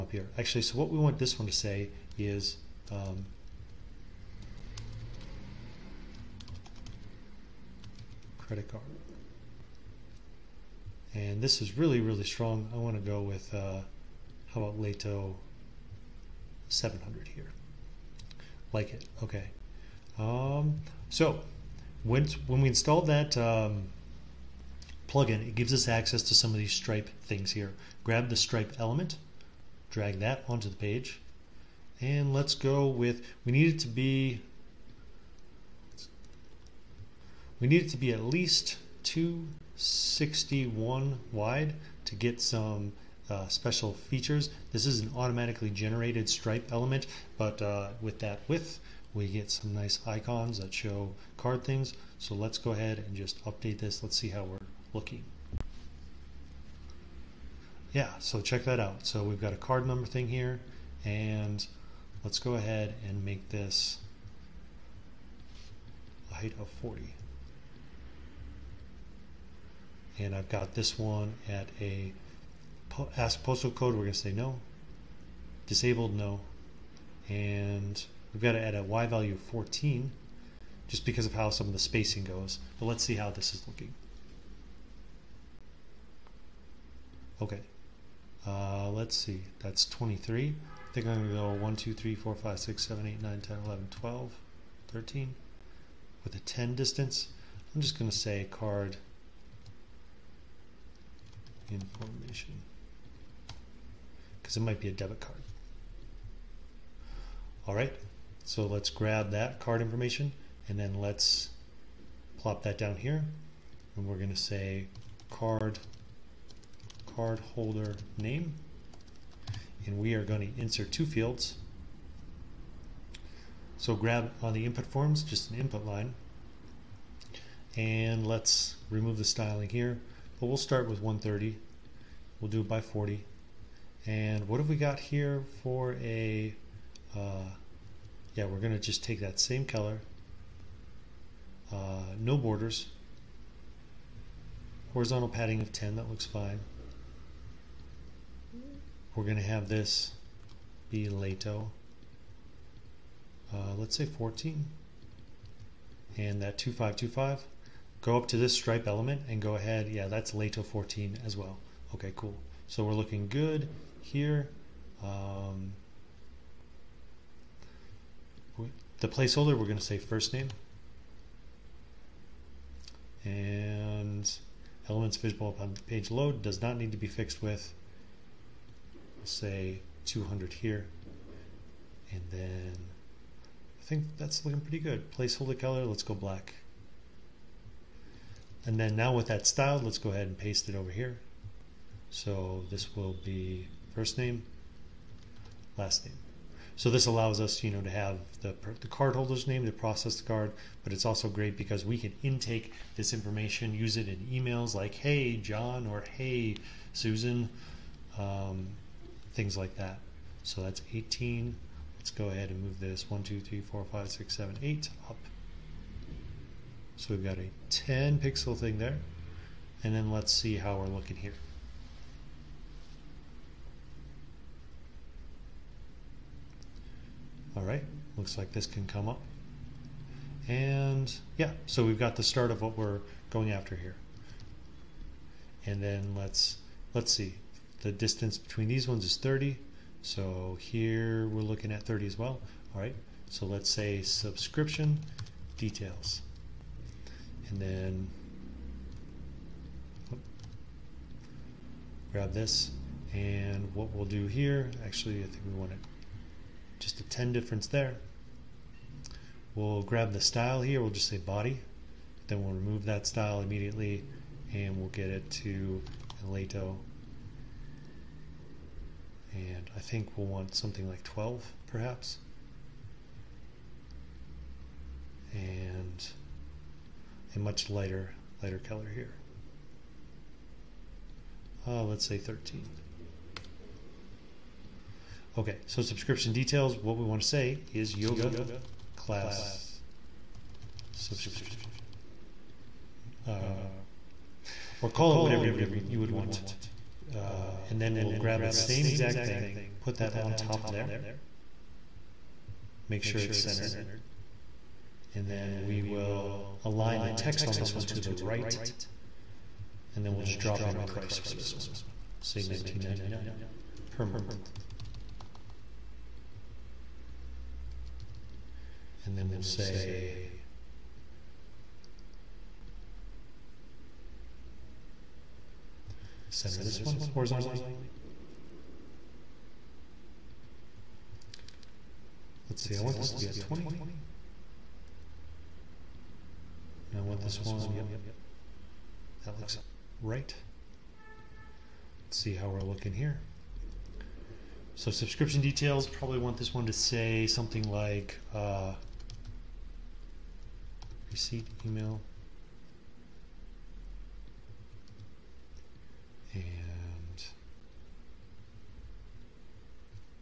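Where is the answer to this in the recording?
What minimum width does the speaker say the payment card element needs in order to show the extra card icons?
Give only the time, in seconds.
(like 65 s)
39 s.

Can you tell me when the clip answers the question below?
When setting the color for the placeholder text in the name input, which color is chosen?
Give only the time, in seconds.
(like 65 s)
186 s.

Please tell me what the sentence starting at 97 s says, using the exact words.
I'm just going to say card information because it might be a debit card.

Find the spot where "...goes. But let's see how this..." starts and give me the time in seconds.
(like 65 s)
82 s.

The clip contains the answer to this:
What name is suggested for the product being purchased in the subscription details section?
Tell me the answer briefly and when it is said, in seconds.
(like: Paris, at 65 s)
Yoga class subscription, at 287 s.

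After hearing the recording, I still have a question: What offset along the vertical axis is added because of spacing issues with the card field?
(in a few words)
14.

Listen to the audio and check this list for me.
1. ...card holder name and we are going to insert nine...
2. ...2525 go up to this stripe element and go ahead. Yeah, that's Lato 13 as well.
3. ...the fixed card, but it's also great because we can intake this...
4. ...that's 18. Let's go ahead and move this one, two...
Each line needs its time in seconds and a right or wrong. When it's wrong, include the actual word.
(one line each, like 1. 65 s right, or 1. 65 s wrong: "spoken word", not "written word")
1. 117 s wrong: "two", not "nine"
2. 156 s wrong: "14", not "13"
3. 199 s wrong: "processed", not "fixed"
4. 210 s right.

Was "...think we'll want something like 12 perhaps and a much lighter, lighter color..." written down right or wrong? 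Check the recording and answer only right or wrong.
right.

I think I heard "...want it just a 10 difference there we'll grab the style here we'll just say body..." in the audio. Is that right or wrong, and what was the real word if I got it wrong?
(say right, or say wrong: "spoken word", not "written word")
right.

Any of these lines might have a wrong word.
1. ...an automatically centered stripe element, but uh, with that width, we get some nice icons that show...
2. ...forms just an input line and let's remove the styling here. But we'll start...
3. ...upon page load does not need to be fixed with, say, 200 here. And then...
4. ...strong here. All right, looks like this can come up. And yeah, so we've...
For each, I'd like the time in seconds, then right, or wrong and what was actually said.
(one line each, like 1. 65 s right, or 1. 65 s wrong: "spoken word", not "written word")
1. 45 s wrong: "generated", not "centered"
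2. 124 s right
3. 175 s right
4. 220 s wrong: "looking", not "strong".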